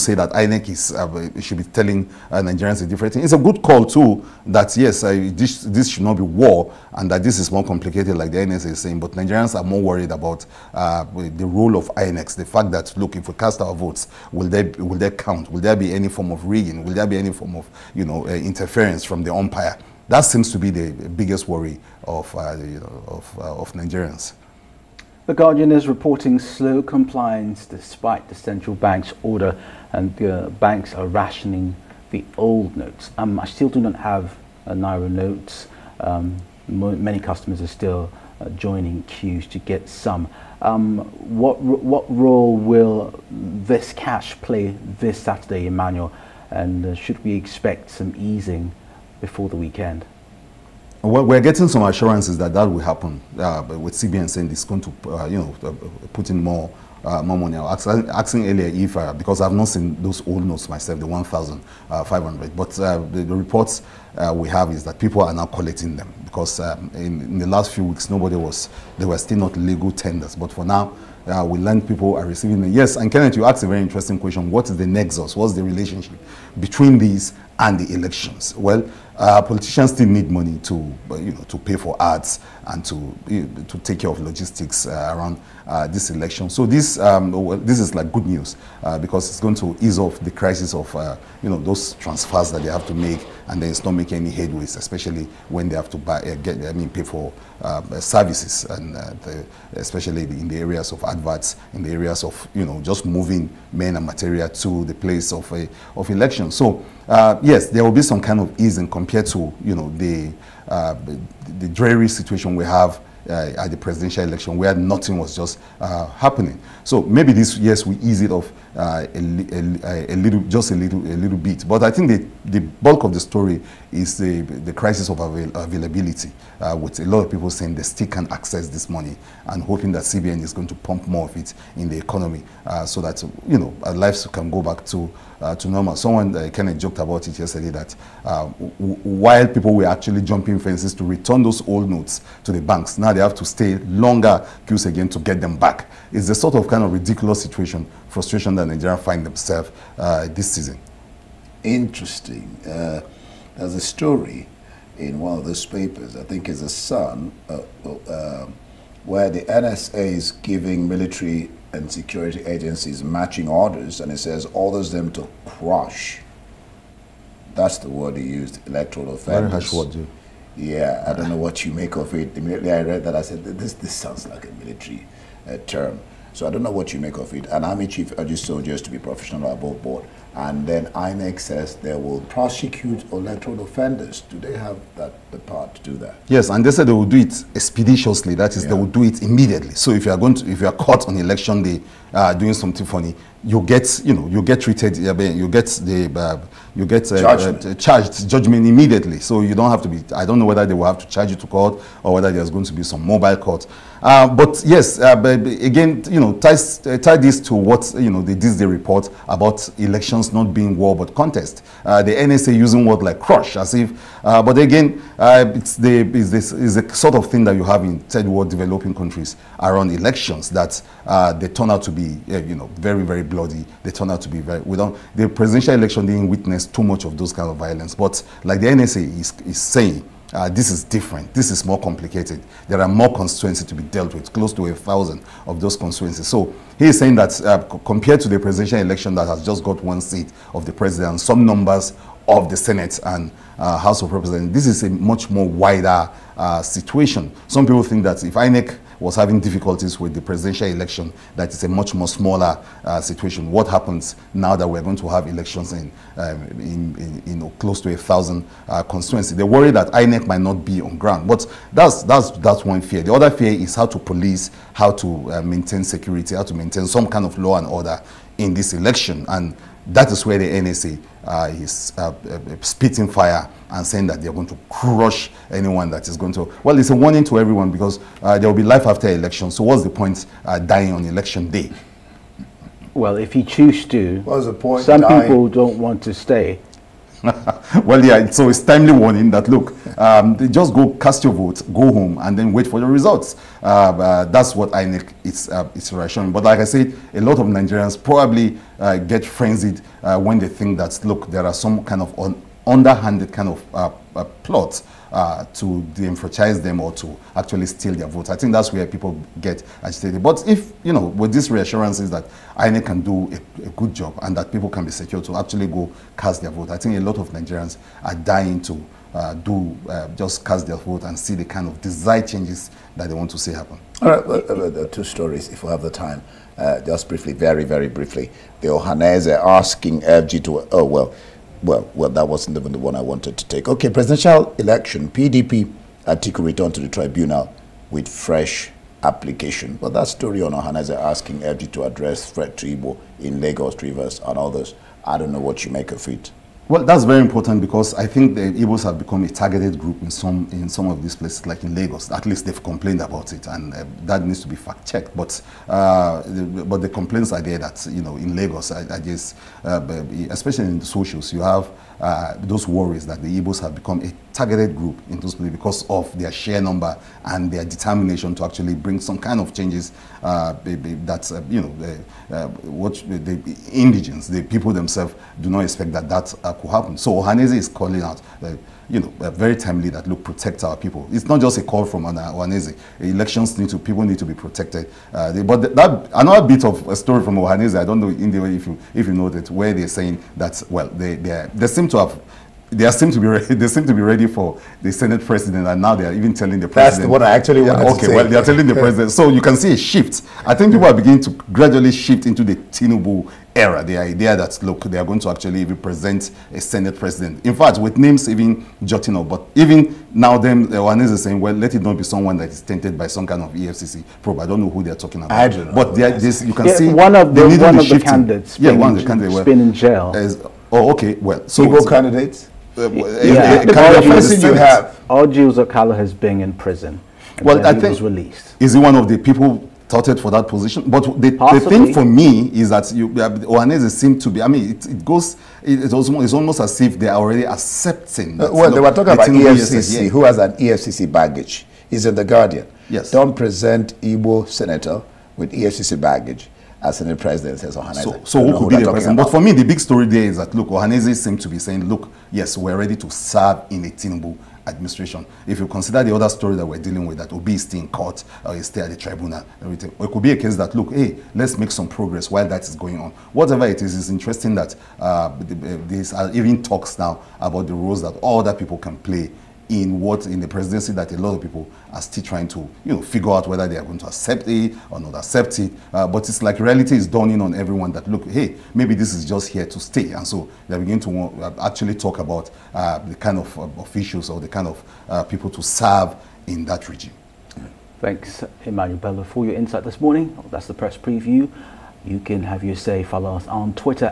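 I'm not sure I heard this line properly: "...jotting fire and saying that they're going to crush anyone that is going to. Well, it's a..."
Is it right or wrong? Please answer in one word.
wrong.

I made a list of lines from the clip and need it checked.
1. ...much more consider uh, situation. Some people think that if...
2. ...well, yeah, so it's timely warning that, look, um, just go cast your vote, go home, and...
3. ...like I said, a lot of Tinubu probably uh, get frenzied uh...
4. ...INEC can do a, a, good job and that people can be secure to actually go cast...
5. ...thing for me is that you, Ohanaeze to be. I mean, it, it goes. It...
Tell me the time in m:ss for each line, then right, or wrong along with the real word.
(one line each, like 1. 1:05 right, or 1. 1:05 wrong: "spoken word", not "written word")
1. 4:04 wrong: "wider", not "consider"
2. 4:47 right
3. 4:56 wrong: "Nigerians", not "Tinubu"
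4. 5:12 right
5. 7:11 right.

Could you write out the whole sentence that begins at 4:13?
What happens now that we're going to have elections in, um, in, in, you know, close to a thousand uh, constituencies?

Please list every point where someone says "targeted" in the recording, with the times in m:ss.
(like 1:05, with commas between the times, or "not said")
5:49, 6:04.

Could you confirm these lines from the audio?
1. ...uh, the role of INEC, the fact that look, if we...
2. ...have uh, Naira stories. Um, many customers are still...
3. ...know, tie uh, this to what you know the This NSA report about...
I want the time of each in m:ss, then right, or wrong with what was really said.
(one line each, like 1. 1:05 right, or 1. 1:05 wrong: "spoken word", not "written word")
1. 0:10 right
2. 0:33 wrong: "notes", not "stories"
3. 3:26 wrong: "Day", not "NSA".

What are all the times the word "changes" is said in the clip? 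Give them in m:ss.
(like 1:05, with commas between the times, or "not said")
5:22, 6:09.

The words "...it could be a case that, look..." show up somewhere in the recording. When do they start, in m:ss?
7:40.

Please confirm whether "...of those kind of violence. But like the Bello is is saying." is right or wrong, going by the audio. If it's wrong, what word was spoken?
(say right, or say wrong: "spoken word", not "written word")
wrong: "NSA", not "Bello".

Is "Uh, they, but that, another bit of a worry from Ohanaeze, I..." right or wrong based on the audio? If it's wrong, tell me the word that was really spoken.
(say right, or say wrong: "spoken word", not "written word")
wrong: "story", not "worry".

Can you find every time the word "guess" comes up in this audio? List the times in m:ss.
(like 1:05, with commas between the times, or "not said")
5:59.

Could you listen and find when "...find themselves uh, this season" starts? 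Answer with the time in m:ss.
2:28.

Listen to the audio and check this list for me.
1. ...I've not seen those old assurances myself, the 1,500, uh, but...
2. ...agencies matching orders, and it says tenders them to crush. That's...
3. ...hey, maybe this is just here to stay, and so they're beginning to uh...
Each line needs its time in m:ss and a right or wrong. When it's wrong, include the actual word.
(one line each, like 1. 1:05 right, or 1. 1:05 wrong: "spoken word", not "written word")
1. 0:59 wrong: "notes", not "assurances"
2. 2:42 wrong: "orders", not "tenders"
3. 7:58 right.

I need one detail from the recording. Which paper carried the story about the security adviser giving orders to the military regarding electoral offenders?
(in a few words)
Sun.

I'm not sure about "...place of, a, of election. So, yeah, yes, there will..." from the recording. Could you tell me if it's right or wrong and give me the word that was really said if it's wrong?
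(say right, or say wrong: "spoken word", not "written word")
right.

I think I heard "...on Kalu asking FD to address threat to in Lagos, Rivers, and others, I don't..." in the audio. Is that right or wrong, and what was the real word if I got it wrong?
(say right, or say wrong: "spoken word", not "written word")
wrong: "Ohanaeze", not "Kalu".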